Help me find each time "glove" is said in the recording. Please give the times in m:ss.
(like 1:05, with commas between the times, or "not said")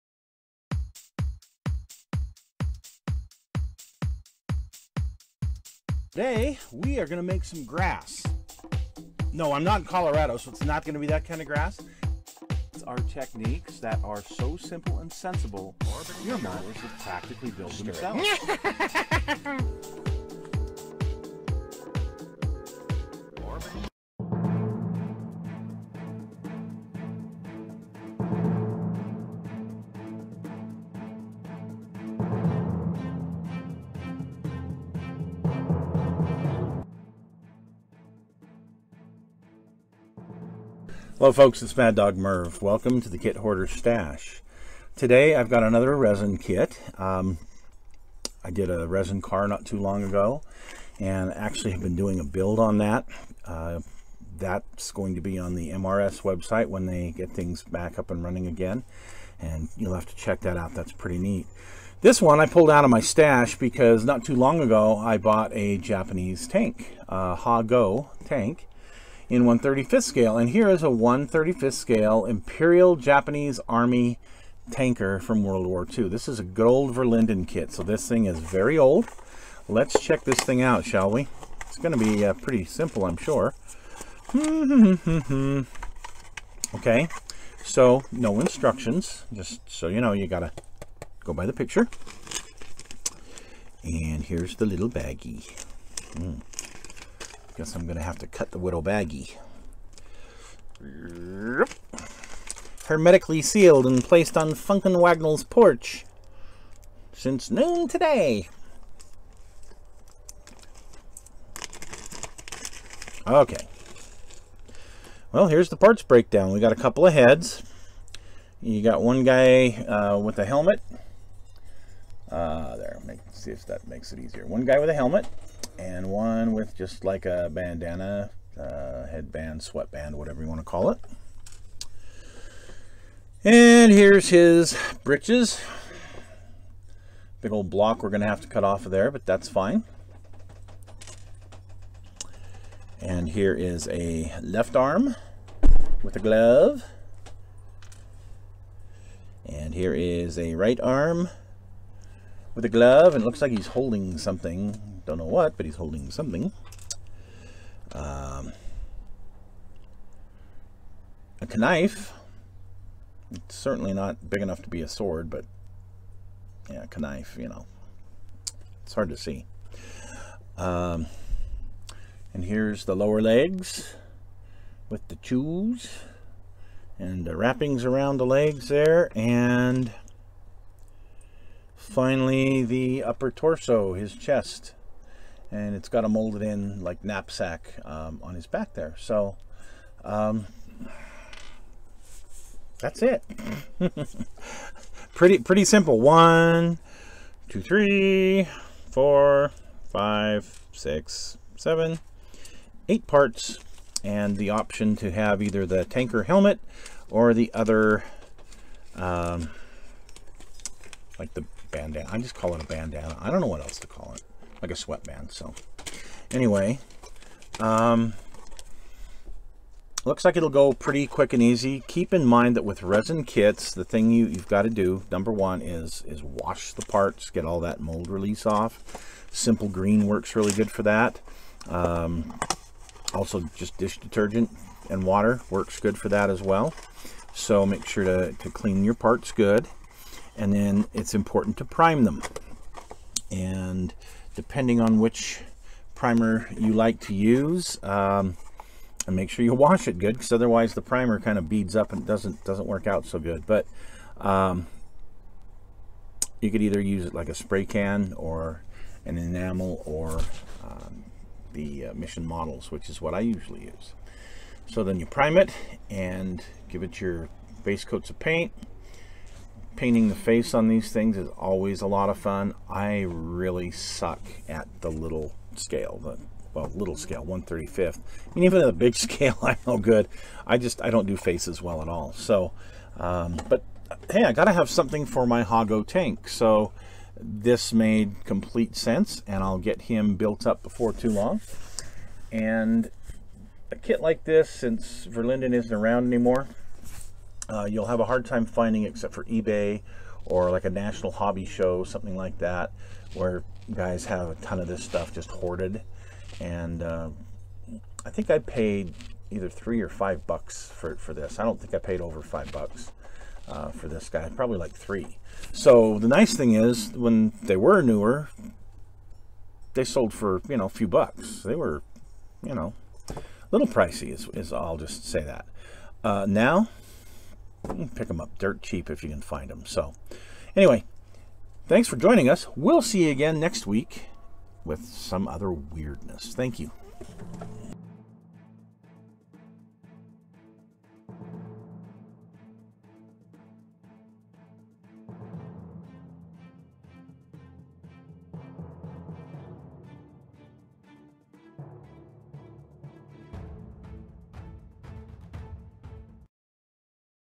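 2:26, 2:32.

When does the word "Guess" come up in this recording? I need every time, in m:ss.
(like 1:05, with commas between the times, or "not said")
1:37.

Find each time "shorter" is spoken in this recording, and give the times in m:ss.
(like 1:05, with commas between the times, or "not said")
not said.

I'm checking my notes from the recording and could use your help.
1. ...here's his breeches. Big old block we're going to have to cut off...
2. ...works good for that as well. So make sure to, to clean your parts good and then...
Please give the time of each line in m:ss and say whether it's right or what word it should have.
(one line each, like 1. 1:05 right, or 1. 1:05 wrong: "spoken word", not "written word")
1. 2:13 right
2. 3:55 right.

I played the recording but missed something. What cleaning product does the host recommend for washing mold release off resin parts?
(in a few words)
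Simple Green.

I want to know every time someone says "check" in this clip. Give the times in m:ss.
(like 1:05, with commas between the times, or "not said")
1:00, 1:20.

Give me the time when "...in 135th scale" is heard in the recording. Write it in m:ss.
1:09.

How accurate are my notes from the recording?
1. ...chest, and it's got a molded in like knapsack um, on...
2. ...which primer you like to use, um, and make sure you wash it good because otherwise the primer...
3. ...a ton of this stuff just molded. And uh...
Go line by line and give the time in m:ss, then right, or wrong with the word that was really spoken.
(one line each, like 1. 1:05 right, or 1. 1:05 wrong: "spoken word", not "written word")
1. 3:04 right
2. 4:04 right
3. 5:04 wrong: "hoarded", not "molded".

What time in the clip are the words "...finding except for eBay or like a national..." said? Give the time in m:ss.
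4:58.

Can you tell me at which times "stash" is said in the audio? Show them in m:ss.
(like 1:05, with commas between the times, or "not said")
0:43, 1:02.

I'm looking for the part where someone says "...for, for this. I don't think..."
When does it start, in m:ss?
5:10.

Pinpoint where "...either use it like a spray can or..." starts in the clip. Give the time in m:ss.
4:16.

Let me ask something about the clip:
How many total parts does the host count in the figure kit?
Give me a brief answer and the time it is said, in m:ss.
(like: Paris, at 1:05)
8, at 3:22.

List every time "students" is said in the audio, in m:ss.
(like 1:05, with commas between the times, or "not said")
not said.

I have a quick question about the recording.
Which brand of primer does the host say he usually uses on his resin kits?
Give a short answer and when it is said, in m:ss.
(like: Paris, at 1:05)
Mission Models, at 4:21.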